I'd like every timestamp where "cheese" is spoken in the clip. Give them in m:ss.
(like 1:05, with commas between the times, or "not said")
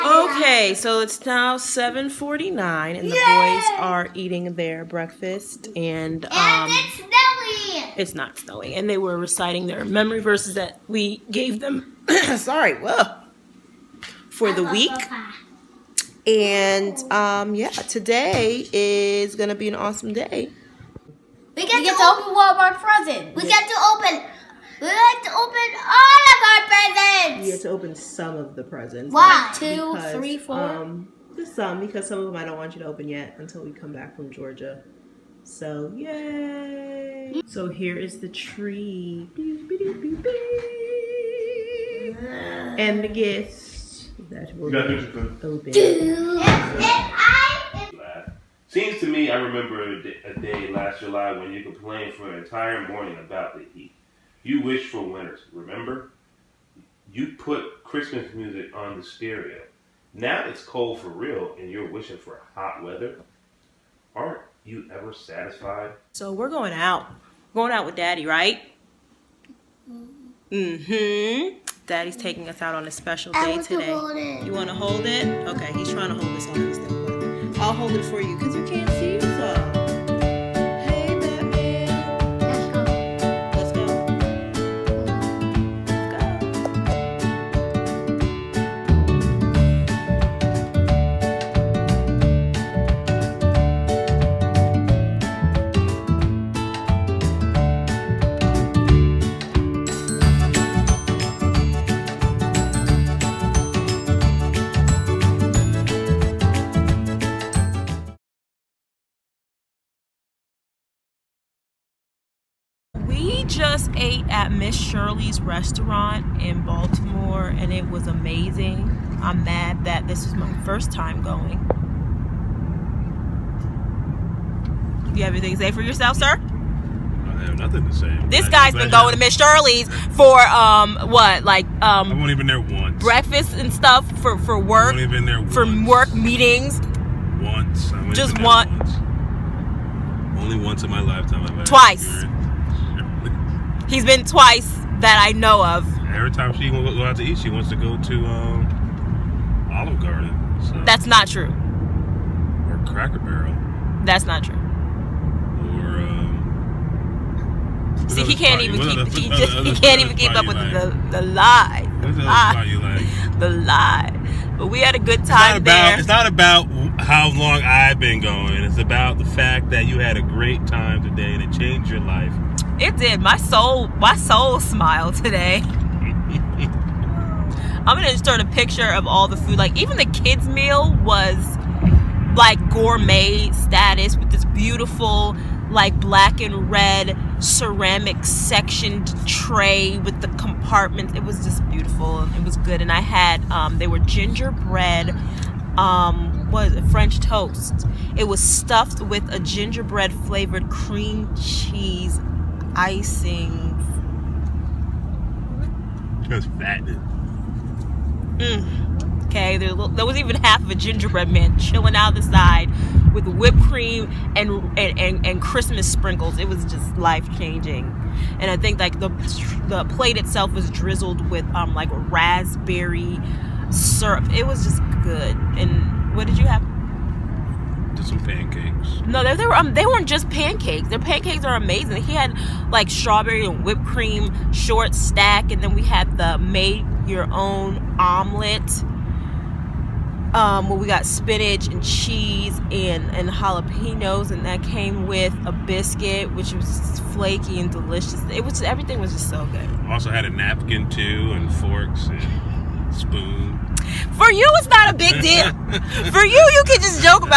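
3:21, 4:01.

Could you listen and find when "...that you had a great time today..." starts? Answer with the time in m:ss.
2:49.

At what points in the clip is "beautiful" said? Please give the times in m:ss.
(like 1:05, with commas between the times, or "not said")
3:04, 3:11.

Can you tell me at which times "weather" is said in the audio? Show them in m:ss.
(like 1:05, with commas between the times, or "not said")
1:02.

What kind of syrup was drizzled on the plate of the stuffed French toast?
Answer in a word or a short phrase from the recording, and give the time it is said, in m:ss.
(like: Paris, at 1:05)
raspberry syrup, at 3:42.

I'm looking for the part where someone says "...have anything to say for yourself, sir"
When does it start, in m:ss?
2:05.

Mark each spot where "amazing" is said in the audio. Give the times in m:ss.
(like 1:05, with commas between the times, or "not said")
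1:58, 3:51.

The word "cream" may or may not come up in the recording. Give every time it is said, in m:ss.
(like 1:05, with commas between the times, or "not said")
3:20, 3:33, 3:53.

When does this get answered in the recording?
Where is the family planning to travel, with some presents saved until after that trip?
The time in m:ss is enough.
0:34.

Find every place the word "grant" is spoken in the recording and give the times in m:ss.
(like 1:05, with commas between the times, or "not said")
not said.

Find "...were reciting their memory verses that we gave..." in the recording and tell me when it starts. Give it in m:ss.
0:08.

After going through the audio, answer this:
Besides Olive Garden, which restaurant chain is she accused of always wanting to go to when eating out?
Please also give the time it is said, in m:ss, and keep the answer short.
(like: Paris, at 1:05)
Cracker Barrel, at 2:32.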